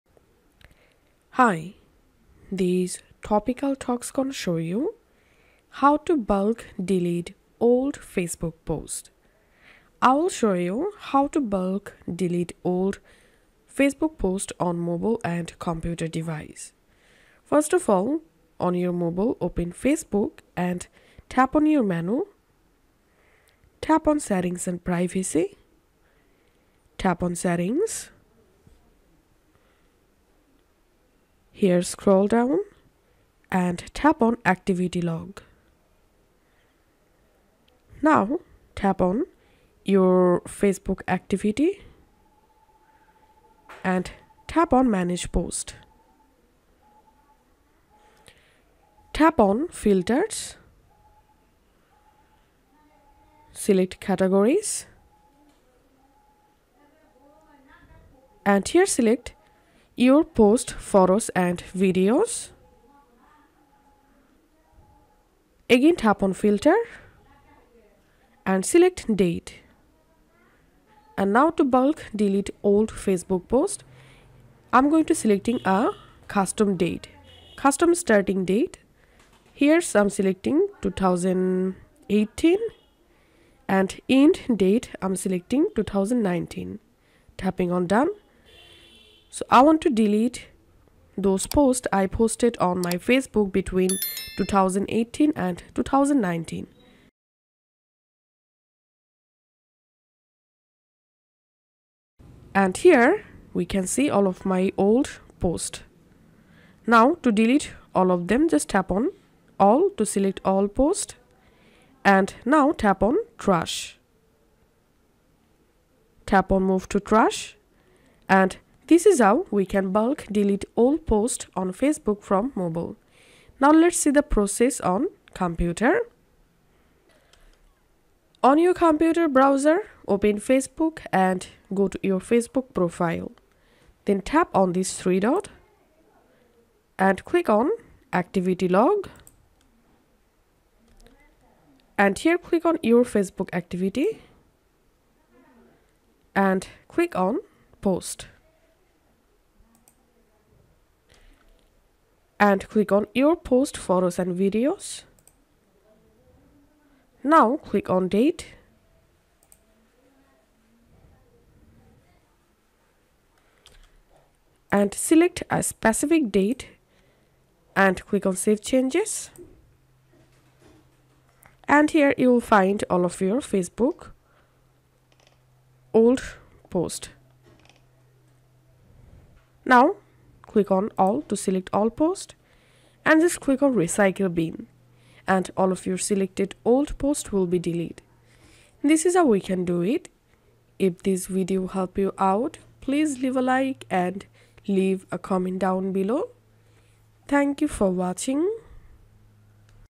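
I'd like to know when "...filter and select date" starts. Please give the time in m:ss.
1:06.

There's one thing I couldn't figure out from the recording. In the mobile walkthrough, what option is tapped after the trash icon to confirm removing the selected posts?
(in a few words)
Move to trash.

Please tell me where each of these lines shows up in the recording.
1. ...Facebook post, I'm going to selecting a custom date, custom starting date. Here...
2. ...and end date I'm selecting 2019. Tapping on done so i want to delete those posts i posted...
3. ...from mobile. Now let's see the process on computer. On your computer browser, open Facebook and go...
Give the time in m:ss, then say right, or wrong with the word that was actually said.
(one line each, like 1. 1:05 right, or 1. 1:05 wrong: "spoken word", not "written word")
1. 1:12 right
2. 1:23 right
3. 2:02 right.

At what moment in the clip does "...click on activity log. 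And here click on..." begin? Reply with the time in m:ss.
2:17.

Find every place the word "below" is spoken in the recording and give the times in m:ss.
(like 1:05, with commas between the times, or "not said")
3:15.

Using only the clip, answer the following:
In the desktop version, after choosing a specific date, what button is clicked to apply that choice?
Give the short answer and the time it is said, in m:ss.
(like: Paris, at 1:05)
Save changes, at 2:48.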